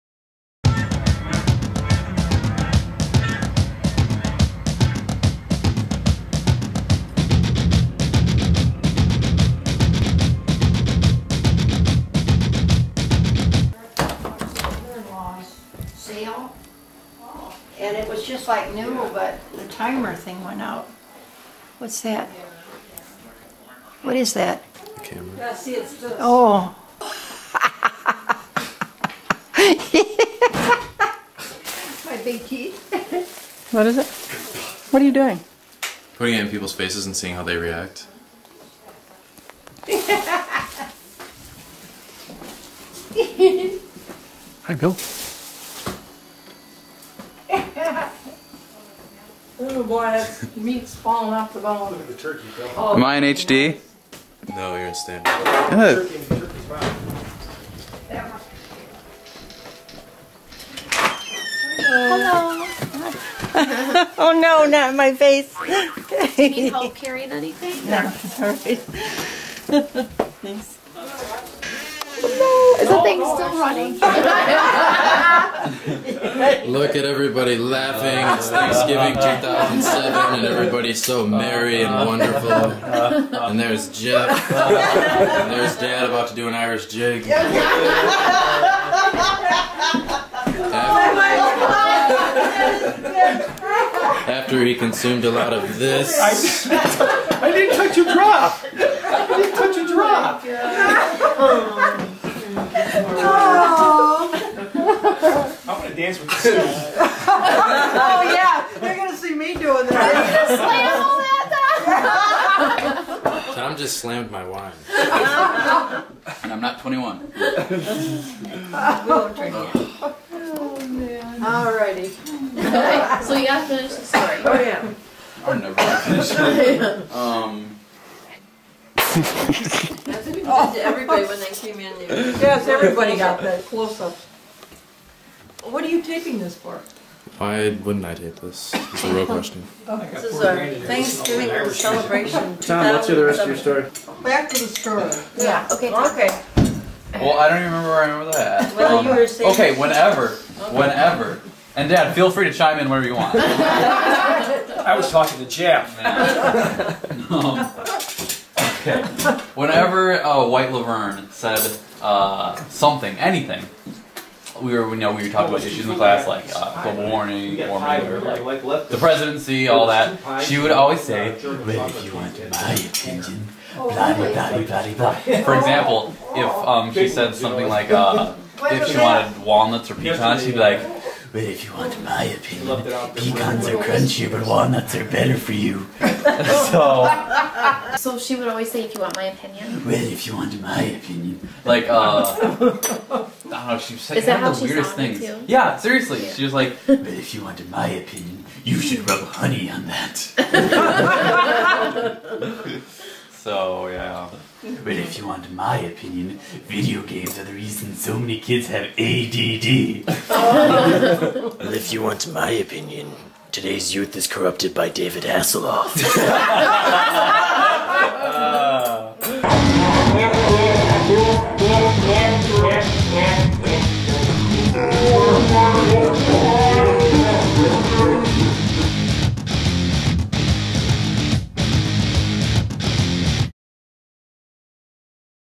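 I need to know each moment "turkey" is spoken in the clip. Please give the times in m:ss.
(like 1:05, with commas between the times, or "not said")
0:52, 0:56.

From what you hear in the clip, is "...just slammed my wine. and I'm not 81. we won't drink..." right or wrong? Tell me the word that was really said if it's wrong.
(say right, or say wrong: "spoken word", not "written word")
wrong: "21", not "81".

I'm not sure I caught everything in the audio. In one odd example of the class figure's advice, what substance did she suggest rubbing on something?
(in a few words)
Honey.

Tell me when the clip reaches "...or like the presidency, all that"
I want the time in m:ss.
2:48.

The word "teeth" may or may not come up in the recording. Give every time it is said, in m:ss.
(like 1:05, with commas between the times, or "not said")
0:32.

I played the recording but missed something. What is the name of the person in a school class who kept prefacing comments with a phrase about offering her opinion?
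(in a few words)
White Laverne.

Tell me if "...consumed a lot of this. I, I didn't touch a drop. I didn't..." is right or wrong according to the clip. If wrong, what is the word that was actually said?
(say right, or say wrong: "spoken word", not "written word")
right.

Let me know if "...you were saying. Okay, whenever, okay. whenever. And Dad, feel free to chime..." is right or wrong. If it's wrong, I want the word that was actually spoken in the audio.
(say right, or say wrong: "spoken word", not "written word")
right.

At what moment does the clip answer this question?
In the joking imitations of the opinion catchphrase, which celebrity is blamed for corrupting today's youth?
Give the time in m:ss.
3:34.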